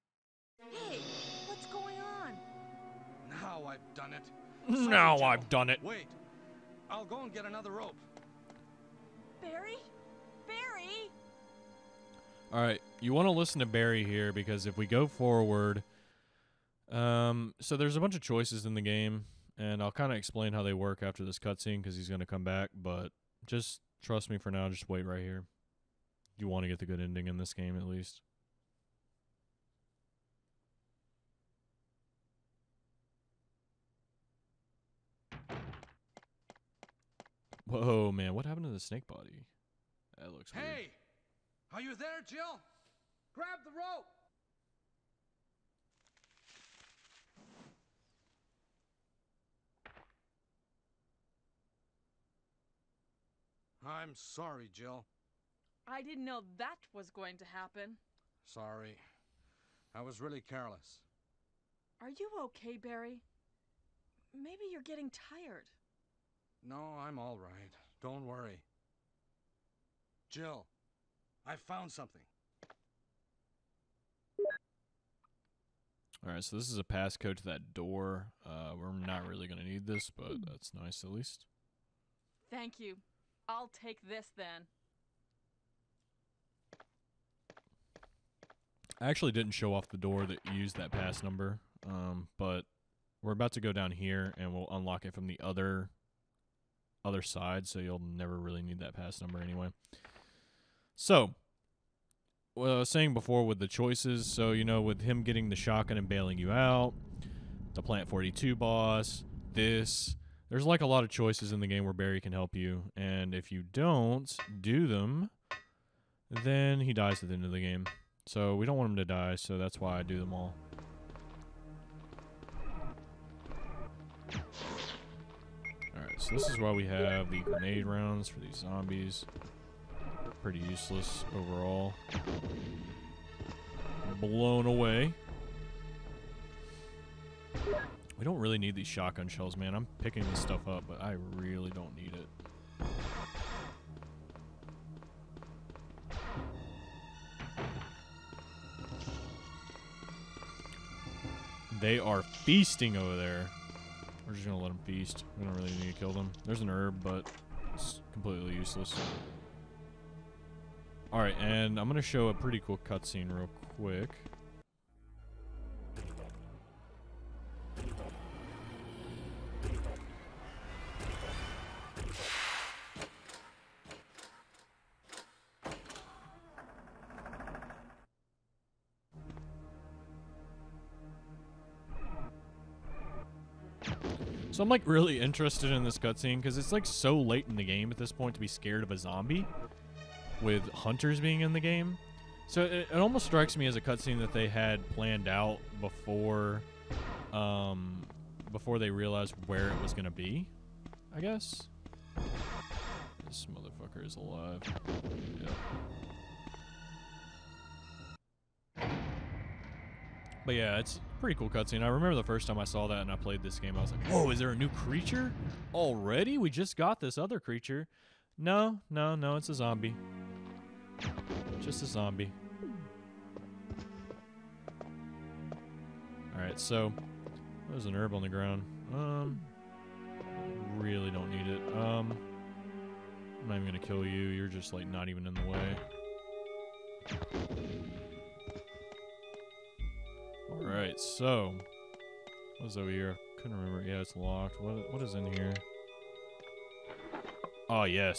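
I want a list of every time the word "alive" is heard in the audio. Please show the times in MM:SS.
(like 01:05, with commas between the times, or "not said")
03:24.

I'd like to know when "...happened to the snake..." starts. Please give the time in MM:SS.
00:38.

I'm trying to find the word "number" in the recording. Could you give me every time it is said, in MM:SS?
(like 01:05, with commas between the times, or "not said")
01:31, 01:39.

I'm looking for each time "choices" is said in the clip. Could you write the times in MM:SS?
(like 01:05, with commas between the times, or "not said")
00:18, 01:43, 01:51.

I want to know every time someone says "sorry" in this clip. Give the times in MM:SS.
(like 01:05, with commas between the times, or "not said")
00:54, 00:58.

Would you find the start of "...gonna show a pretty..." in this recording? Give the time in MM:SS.
02:41.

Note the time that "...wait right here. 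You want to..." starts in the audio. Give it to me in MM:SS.
00:24.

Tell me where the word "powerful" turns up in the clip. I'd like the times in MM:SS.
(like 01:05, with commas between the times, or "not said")
not said.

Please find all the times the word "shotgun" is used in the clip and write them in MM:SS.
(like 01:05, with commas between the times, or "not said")
01:45, 02:18.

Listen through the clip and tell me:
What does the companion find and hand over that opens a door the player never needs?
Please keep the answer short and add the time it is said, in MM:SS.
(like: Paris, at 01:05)
A passcode, at 01:16.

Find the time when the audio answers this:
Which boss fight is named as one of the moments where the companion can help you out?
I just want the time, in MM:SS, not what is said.
01:47.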